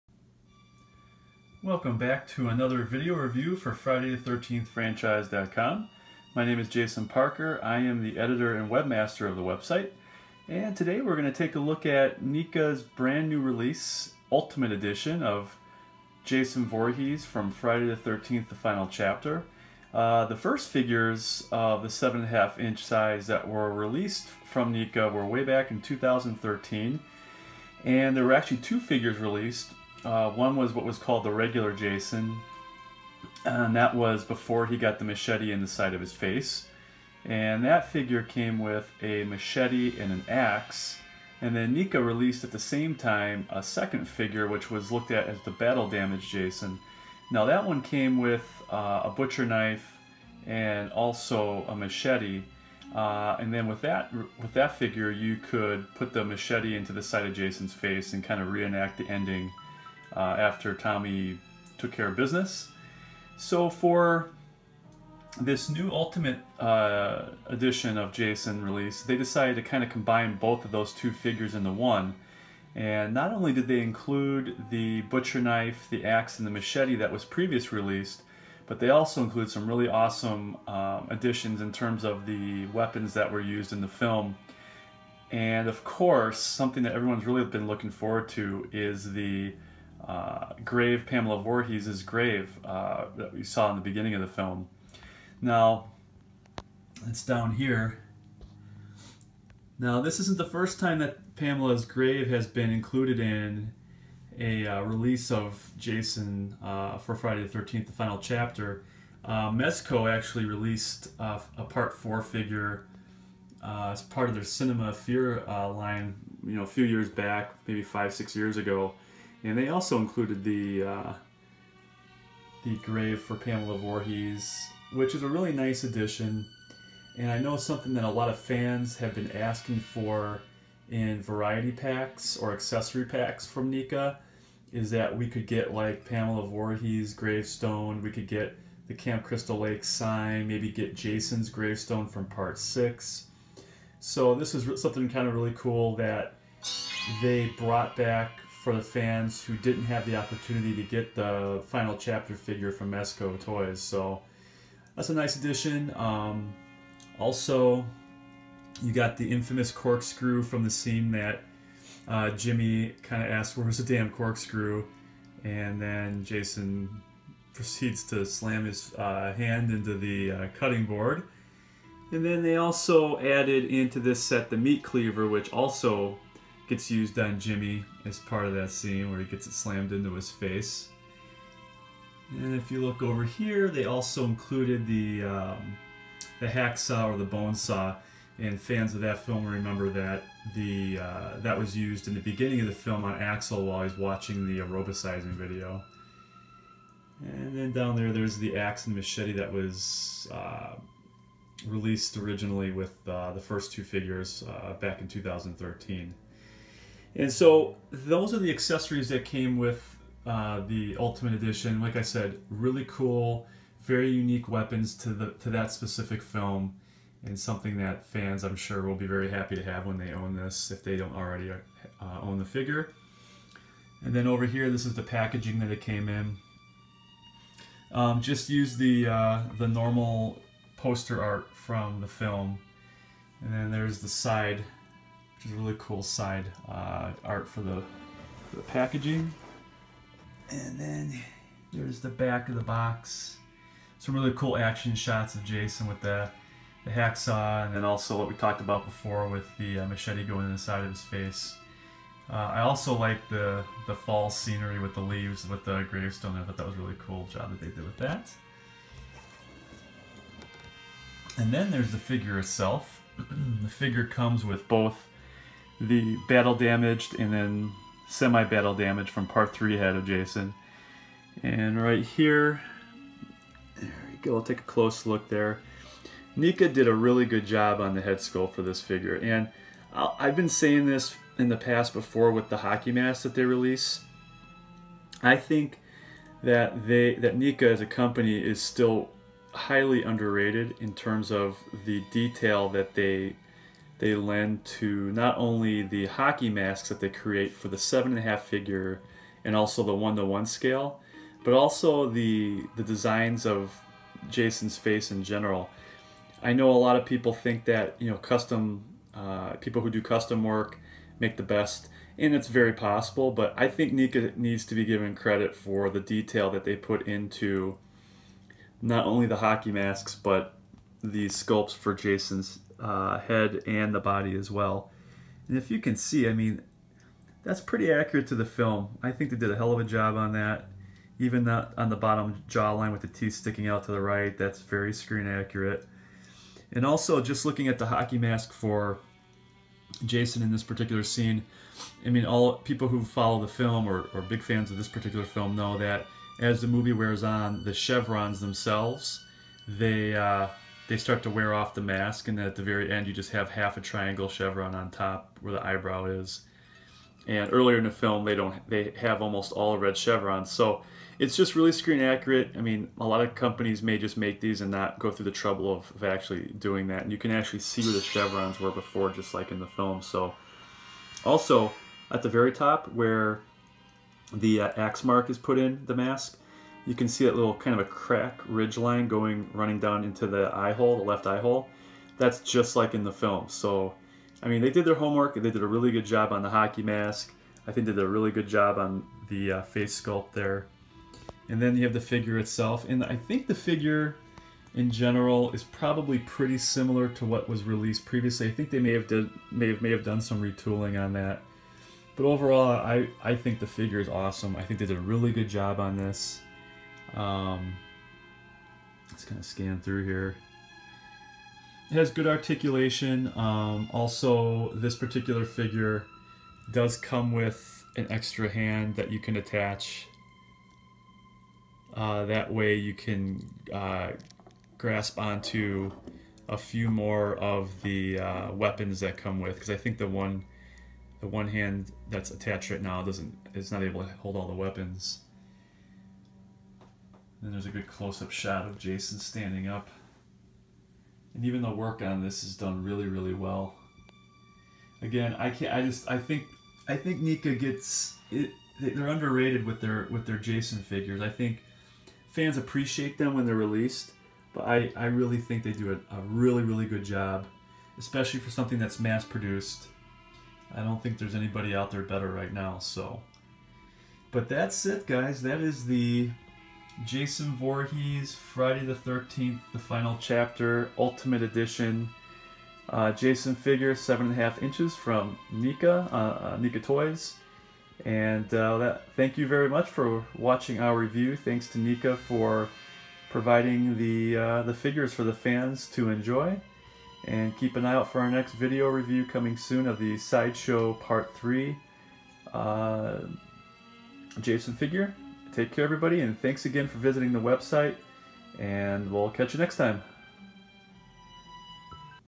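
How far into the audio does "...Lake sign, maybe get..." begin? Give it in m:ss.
2:19.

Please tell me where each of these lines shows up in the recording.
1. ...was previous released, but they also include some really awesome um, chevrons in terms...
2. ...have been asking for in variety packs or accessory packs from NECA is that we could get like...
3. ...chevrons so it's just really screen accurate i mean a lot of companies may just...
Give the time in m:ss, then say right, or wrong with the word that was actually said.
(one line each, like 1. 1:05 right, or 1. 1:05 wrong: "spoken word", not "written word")
1. 1:17 wrong: "additions", not "chevrons"
2. 2:08 right
3. 5:59 right.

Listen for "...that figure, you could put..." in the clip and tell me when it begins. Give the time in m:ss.
0:54.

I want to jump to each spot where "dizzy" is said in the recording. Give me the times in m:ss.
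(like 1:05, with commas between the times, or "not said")
not said.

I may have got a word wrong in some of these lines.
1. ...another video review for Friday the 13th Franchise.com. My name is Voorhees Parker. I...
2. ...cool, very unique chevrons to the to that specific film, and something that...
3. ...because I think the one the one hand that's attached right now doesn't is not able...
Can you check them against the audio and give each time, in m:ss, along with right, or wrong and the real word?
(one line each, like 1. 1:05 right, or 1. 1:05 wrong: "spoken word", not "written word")
1. 0:02 wrong: "Jason", not "Voorhees"
2. 3:32 wrong: "weapons", not "chevrons"
3. 7:09 right.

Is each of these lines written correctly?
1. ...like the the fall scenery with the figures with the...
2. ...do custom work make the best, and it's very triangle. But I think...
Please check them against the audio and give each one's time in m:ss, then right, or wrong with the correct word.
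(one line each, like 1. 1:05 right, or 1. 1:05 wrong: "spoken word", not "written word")
1. 4:12 wrong: "leaves", not "figures"
2. 5:09 wrong: "possible", not "triangle".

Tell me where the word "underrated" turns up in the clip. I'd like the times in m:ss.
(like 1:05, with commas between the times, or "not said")
4:50, 7:29.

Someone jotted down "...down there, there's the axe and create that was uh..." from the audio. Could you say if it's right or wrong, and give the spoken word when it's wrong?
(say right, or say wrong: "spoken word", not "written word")
wrong: "machete", not "create".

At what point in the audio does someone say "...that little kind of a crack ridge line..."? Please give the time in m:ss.
6:17.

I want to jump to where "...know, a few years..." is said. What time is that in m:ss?
1:56.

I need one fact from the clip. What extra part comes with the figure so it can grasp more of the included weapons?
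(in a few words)
an extra hand.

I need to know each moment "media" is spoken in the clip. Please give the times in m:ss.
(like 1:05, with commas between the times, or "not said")
not said.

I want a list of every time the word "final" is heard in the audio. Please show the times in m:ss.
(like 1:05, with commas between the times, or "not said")
0:18, 1:47, 2:31, 7:49.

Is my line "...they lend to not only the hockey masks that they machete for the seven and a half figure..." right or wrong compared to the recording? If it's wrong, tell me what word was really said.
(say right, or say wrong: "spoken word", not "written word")
wrong: "create", not "machete".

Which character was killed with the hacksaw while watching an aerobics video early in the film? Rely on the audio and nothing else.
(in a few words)
Axel.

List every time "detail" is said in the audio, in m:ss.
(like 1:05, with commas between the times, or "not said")
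4:52, 5:15.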